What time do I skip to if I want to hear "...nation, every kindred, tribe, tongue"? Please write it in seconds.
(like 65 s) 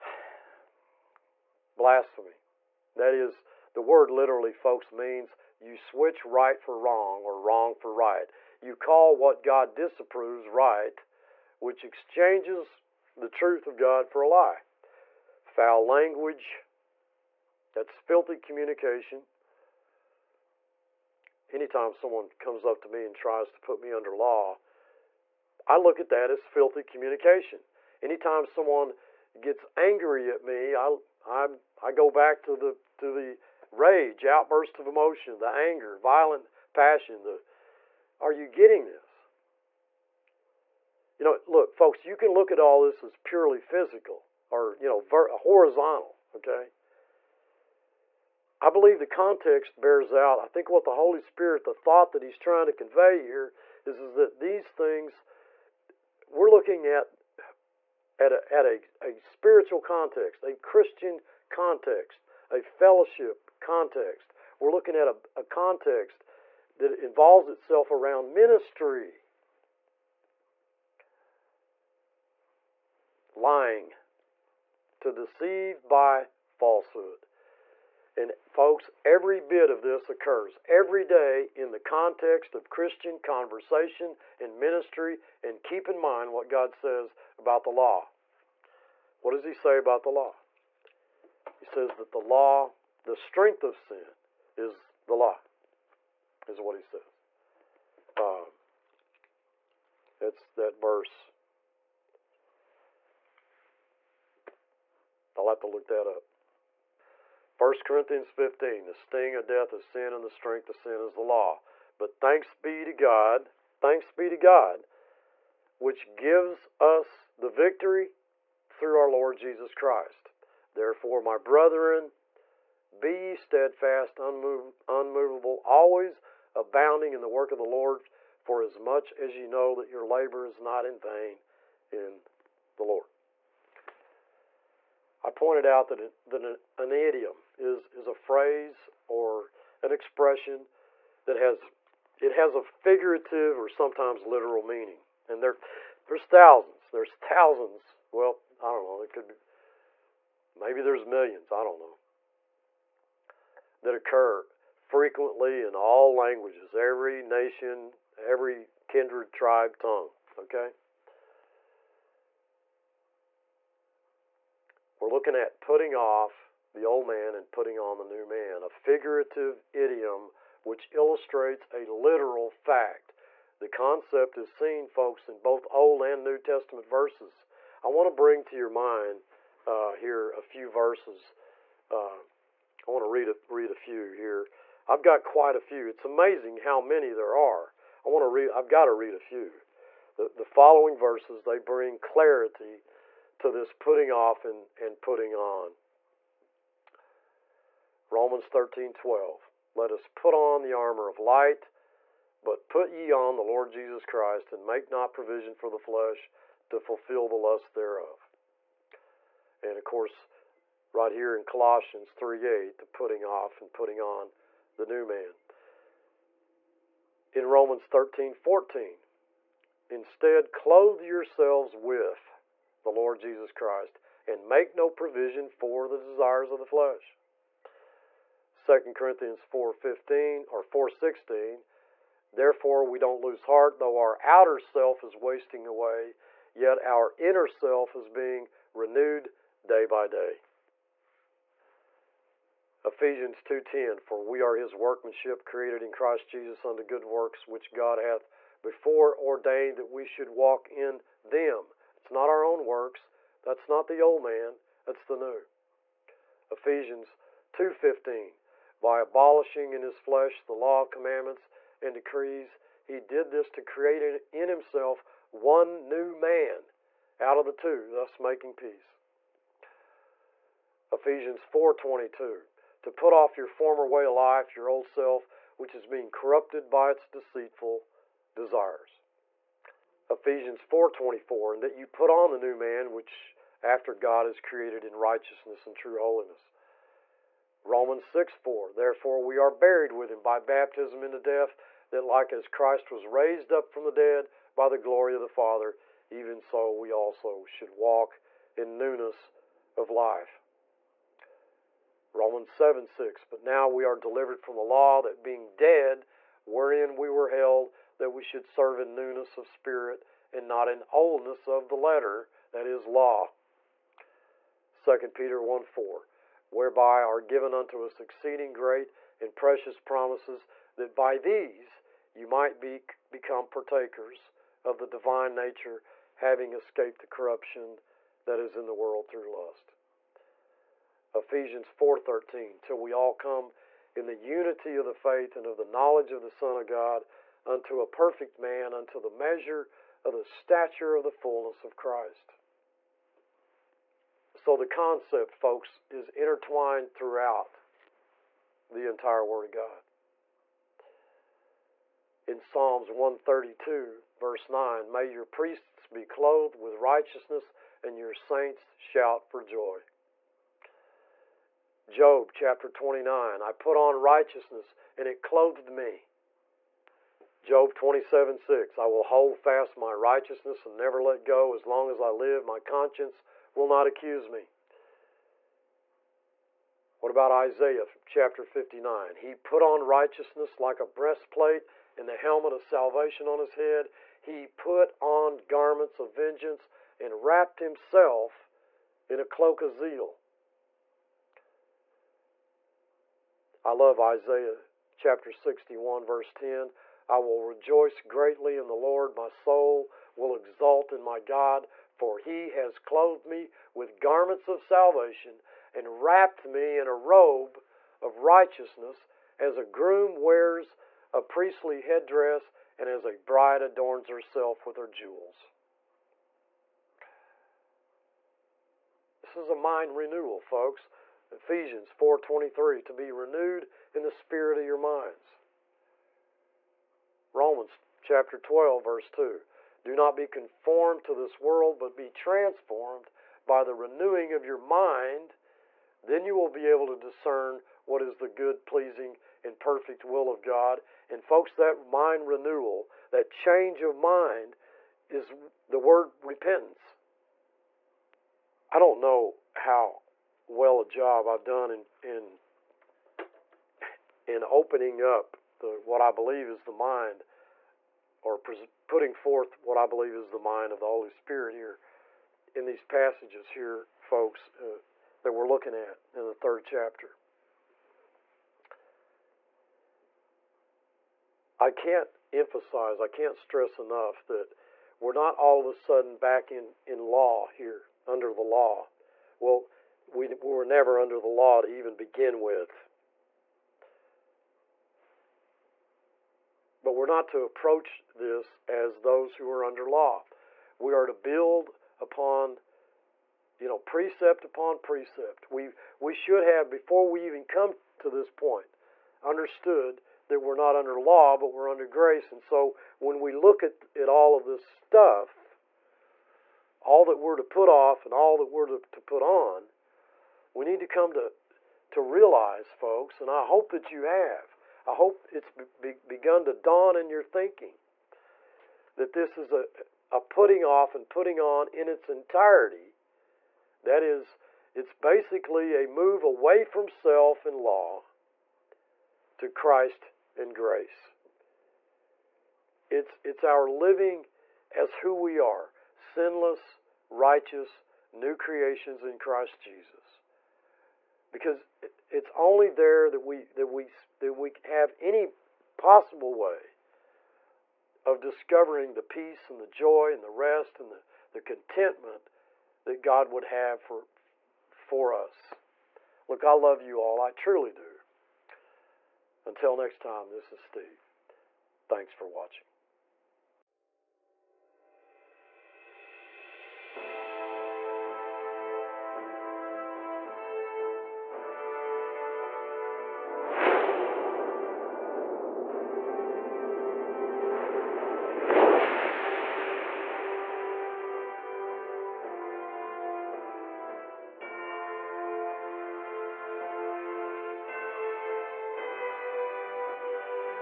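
157 s.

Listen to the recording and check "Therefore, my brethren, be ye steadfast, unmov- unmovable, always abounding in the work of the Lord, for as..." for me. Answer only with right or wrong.
right.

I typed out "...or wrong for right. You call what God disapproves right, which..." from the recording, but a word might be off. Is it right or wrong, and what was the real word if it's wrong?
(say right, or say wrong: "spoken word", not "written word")
right.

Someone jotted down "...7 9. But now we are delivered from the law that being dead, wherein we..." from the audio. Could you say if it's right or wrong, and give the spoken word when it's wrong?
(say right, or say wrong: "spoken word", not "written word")
wrong: "6", not "9".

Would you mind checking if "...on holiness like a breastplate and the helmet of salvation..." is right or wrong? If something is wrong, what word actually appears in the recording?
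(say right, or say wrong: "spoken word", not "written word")
wrong: "righteousness", not "holiness".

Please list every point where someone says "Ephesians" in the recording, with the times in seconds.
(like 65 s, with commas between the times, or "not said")
242 s, 256 s, 270 s, 280 s, 331 s, 421 s.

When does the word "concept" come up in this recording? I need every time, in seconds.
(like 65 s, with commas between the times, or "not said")
173 s, 344 s.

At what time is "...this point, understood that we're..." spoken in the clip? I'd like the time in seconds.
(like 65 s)
498 s.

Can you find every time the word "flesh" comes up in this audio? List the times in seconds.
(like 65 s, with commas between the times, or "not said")
205 s, 226 s, 259 s.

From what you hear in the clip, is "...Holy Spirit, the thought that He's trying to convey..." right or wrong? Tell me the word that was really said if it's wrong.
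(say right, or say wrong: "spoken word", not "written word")
right.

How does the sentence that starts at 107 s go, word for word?
1 Corinthians 15 The sting of death is sin, and the strength of sin is the law.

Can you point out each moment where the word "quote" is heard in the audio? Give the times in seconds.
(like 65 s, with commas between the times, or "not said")
not said.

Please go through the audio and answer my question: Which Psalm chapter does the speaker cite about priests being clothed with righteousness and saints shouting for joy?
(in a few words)
Psalms 132.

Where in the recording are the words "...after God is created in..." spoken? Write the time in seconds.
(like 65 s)
283 s.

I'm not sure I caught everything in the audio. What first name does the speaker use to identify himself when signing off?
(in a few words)
Steve.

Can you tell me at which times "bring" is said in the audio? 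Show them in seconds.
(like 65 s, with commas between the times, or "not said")
178 s, 191 s.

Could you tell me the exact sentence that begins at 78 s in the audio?
And folks, every bit of this occurs every day in the context of Christian conversation and ministry.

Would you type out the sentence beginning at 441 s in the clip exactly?
And folks, that mind renewal, that change of mind is the word repentance.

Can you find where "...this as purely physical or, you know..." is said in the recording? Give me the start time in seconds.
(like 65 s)
42 s.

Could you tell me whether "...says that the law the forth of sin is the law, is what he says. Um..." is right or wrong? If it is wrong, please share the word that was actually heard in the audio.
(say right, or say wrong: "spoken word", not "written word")
wrong: "strength", not "forth".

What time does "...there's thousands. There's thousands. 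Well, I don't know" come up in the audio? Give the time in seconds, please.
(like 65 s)
146 s.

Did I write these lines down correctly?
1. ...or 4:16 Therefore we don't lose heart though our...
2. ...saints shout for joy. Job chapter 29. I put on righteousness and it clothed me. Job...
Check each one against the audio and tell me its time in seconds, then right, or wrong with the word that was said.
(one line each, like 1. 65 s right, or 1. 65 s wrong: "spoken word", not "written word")
1. 230 s right
2. 358 s right.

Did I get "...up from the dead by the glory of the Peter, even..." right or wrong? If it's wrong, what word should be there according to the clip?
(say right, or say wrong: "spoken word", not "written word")
wrong: "Father", not "Peter".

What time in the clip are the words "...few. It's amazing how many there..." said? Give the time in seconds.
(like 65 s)
185 s.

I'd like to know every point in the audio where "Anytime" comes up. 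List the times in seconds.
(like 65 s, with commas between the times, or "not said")
21 s, 28 s.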